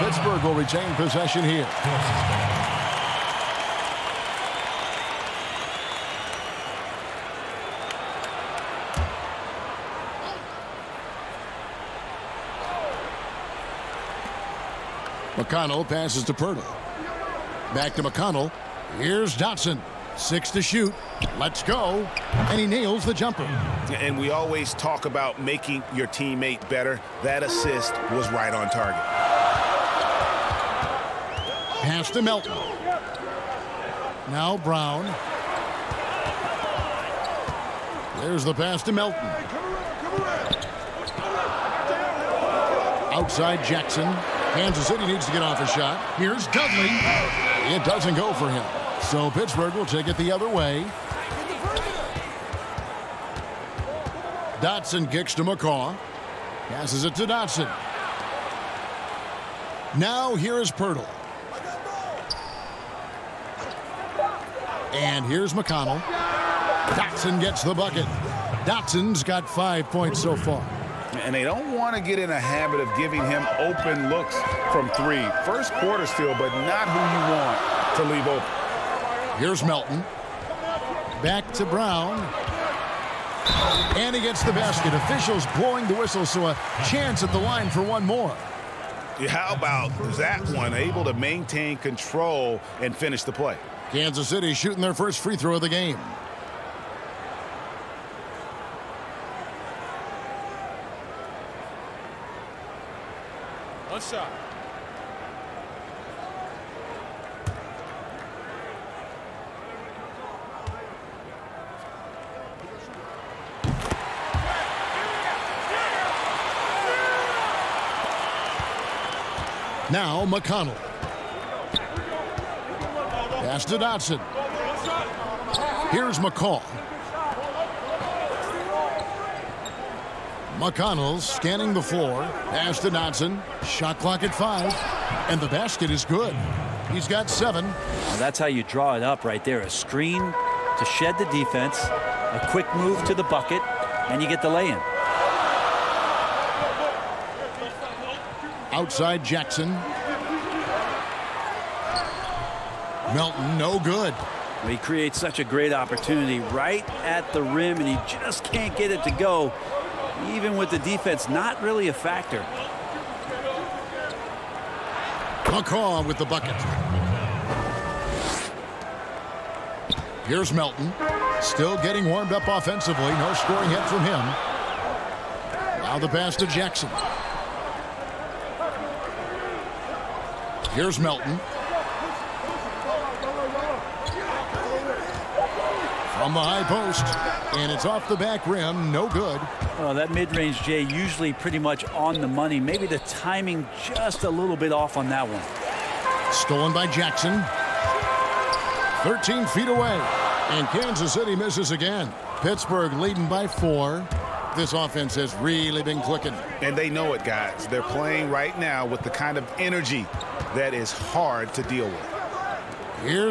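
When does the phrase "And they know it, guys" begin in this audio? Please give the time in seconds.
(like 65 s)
206 s.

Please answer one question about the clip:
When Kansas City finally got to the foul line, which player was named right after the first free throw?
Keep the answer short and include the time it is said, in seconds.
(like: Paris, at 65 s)
Mensah, at 104 s.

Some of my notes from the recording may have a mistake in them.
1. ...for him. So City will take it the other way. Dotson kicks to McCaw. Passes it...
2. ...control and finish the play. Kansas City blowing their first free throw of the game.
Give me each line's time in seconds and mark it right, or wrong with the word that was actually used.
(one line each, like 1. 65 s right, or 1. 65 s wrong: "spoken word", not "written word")
1. 48 s wrong: "Pittsburgh", not "City"
2. 91 s wrong: "shooting", not "blowing".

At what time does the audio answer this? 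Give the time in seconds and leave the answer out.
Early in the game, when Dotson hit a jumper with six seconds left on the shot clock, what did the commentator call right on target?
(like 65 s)
27 s.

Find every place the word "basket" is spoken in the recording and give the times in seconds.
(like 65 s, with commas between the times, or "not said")
84 s, 135 s.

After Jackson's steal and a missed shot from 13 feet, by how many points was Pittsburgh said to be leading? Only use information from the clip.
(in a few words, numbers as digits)
4.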